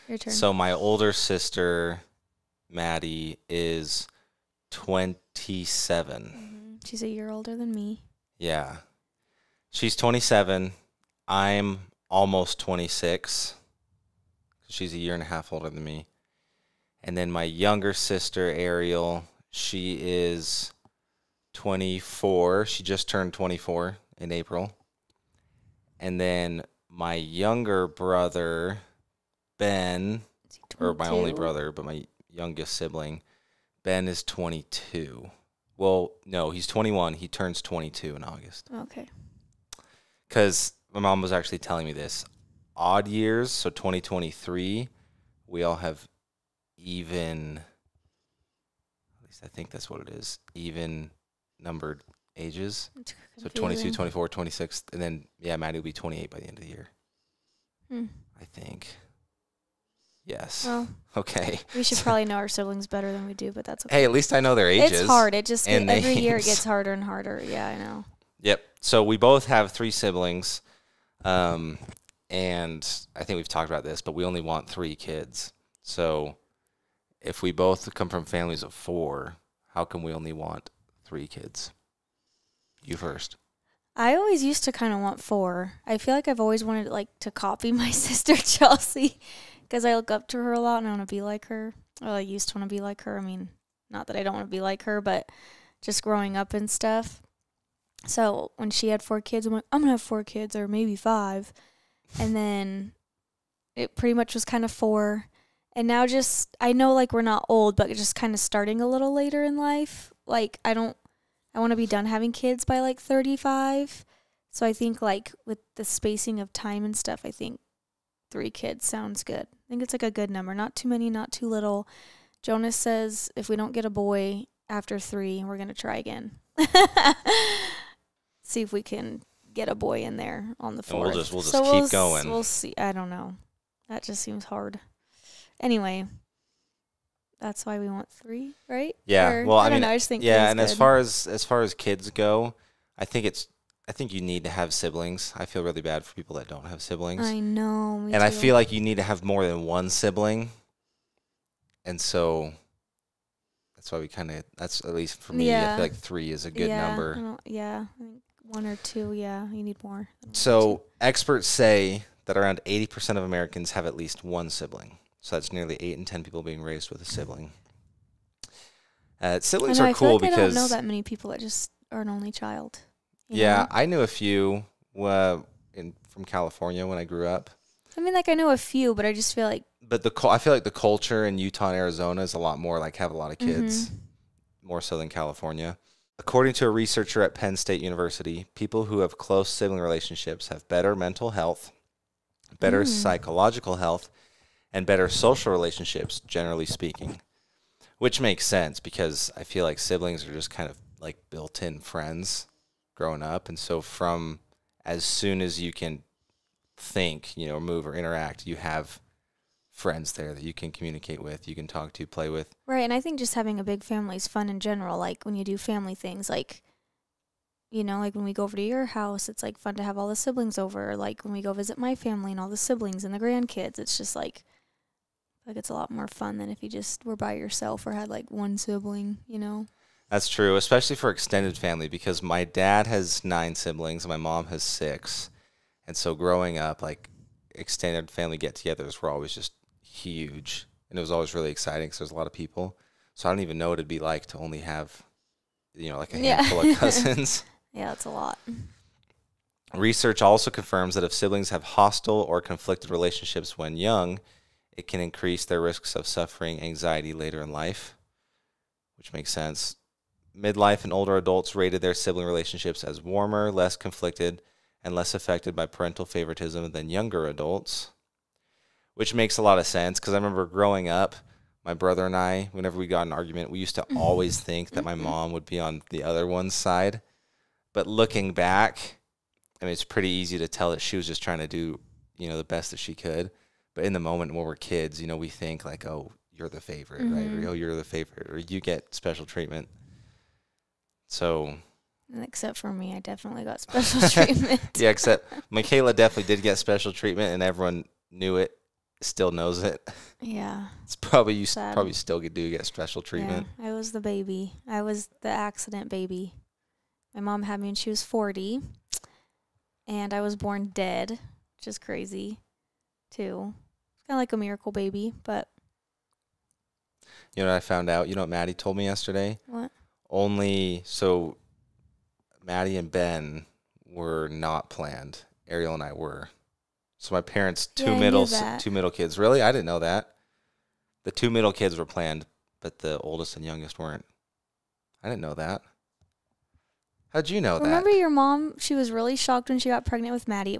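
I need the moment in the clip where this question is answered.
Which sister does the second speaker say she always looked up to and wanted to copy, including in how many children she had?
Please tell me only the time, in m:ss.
1:28.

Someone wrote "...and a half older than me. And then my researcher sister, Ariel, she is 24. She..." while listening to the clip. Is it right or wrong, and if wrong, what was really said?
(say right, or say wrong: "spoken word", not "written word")
wrong: "younger", not "researcher".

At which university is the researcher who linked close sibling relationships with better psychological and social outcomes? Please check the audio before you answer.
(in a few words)
Penn State University.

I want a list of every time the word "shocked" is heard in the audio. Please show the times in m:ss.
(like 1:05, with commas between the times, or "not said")
5:39.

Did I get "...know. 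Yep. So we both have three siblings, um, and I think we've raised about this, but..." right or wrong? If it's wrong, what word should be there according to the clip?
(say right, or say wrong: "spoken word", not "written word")
wrong: "talked", not "raised".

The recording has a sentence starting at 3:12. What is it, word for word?
psychological health, and better social relationships, generally speaking.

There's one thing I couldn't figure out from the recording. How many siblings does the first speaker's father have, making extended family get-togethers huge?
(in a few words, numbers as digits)
9.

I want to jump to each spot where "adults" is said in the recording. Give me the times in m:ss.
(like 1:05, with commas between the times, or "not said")
4:21, 4:27.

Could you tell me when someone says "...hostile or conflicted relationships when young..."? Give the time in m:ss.
4:11.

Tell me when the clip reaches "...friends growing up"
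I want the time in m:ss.
3:21.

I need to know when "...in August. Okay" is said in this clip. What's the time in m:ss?
0:38.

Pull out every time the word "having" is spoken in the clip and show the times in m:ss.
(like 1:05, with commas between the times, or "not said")
1:52, 3:33.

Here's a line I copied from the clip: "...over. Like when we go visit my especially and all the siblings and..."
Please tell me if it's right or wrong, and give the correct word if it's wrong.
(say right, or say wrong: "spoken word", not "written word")
wrong: "family", not "especially".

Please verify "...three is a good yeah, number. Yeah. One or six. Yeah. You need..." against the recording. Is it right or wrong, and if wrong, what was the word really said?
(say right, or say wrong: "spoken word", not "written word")
wrong: "two", not "six".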